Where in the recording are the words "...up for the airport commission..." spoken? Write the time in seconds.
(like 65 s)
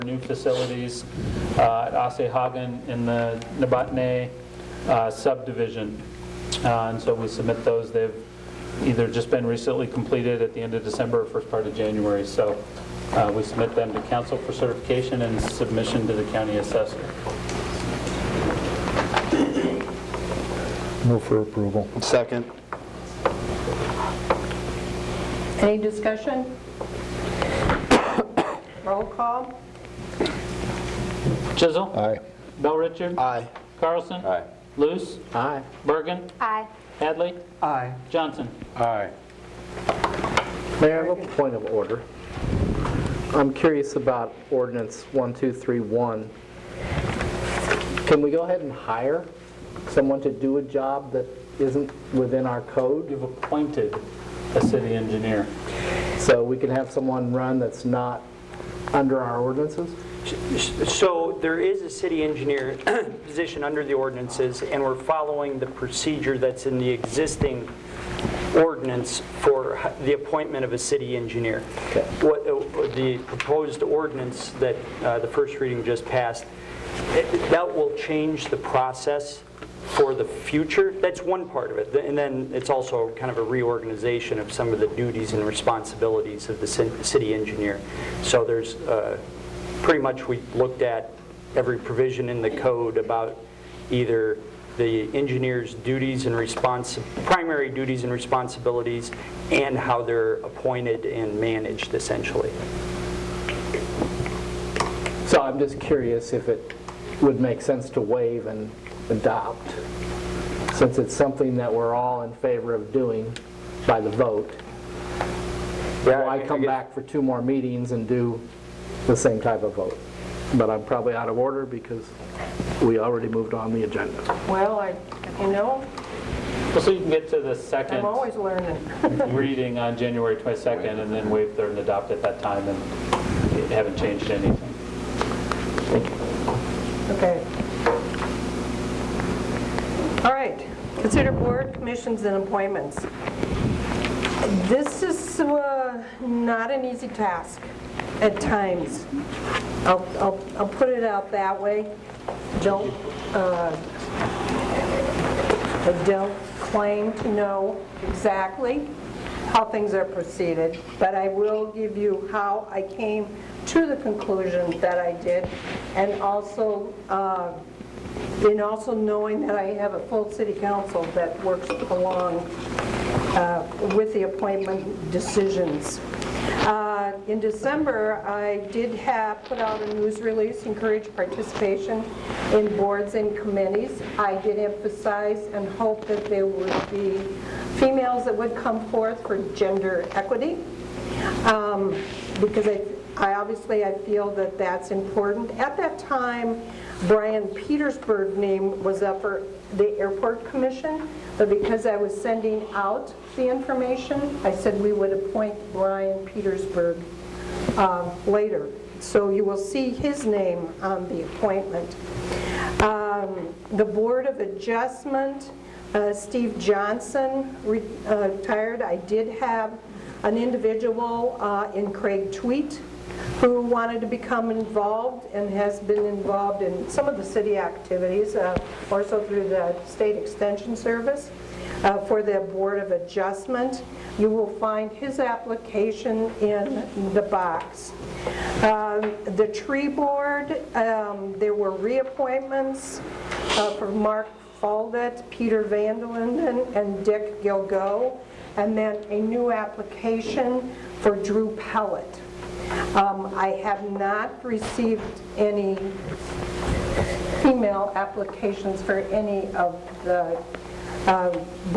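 199 s.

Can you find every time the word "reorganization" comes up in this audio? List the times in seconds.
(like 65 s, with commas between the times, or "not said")
83 s.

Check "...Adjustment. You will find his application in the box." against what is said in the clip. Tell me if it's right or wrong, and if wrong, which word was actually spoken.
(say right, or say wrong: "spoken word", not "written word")
right.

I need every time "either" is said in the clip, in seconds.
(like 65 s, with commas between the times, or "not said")
8 s, 93 s.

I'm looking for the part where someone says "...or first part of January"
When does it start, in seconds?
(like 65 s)
11 s.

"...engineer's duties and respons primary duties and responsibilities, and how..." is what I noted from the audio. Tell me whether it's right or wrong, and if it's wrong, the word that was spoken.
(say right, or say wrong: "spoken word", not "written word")
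right.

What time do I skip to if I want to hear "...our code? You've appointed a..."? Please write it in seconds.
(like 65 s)
52 s.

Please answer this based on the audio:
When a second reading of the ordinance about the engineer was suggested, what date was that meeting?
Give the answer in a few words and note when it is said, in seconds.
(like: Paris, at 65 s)
January 22nd, at 129 s.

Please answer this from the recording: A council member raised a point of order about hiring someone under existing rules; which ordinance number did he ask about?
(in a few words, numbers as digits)
1231.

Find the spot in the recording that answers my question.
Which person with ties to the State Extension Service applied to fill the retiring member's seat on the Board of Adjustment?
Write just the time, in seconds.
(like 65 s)
221 s.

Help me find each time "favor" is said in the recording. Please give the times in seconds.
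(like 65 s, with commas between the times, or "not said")
112 s.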